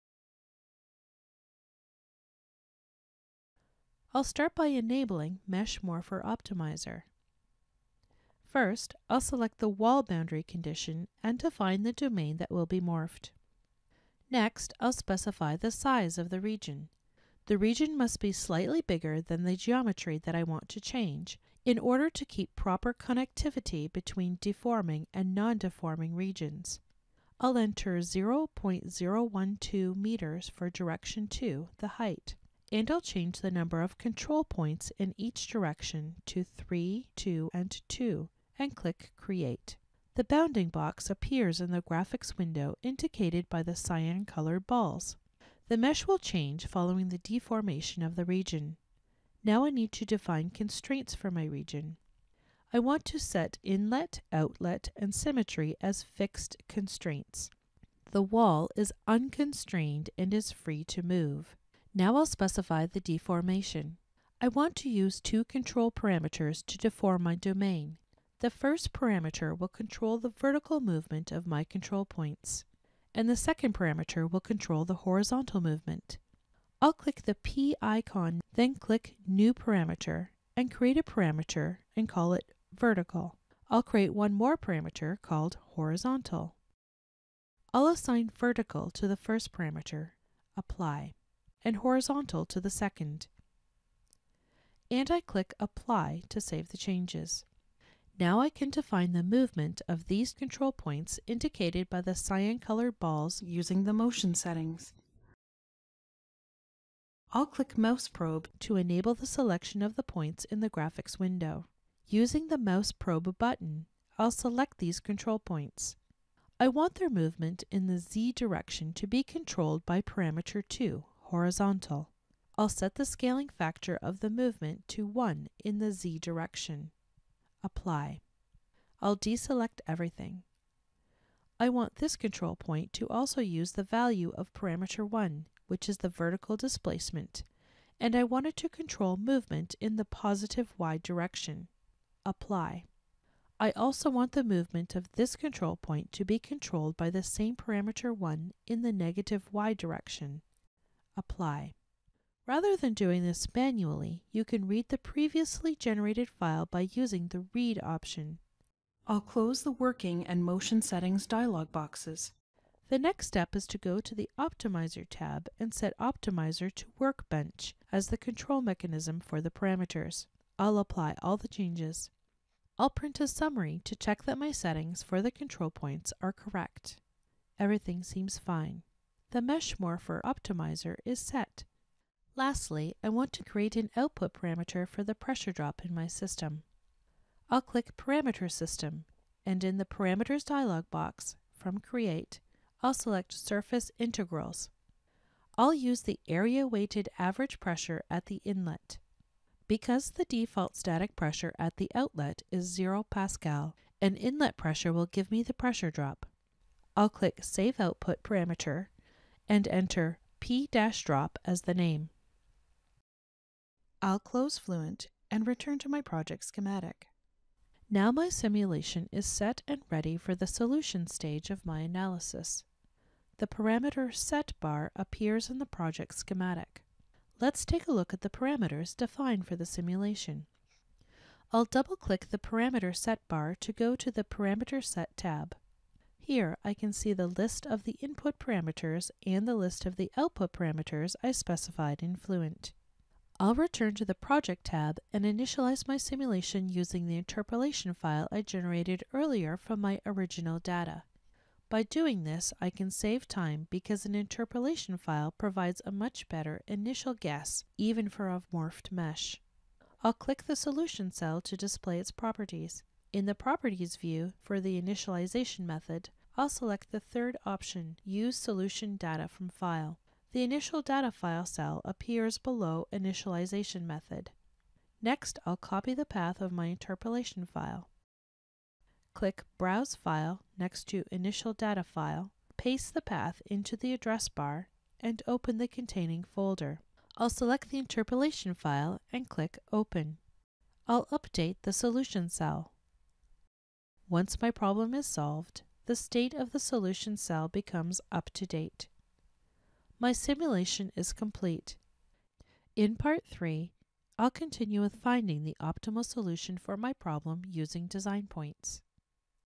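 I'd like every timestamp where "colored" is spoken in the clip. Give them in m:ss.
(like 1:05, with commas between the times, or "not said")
0:44, 1:42.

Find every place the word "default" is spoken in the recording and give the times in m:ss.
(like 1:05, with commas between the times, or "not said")
3:20.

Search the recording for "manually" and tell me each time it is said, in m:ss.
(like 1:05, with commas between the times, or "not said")
2:33.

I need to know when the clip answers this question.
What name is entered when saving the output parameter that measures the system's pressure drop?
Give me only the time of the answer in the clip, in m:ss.
3:30.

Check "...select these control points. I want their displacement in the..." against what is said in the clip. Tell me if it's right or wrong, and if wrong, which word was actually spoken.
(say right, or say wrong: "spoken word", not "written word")
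wrong: "movement", not "displacement".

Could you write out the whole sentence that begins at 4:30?
The Initial Data File cell appears below Initialization Method.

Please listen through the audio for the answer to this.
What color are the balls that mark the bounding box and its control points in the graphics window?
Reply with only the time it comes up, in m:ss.
0:43.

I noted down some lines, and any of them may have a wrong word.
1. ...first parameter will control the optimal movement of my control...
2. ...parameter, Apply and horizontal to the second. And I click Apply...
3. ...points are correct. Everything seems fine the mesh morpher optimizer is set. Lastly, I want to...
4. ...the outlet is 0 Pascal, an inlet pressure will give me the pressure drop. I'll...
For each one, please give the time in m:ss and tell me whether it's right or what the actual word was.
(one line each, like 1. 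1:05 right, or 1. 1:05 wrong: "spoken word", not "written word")
1. 1:08 wrong: "vertical", not "optimal"
2. 1:29 right
3. 2:55 right
4. 3:21 right.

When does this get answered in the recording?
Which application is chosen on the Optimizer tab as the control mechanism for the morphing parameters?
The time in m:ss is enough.
2:46.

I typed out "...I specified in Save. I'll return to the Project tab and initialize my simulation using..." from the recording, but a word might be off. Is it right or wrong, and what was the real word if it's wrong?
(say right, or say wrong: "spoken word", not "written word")
wrong: "Fluent", not "Save".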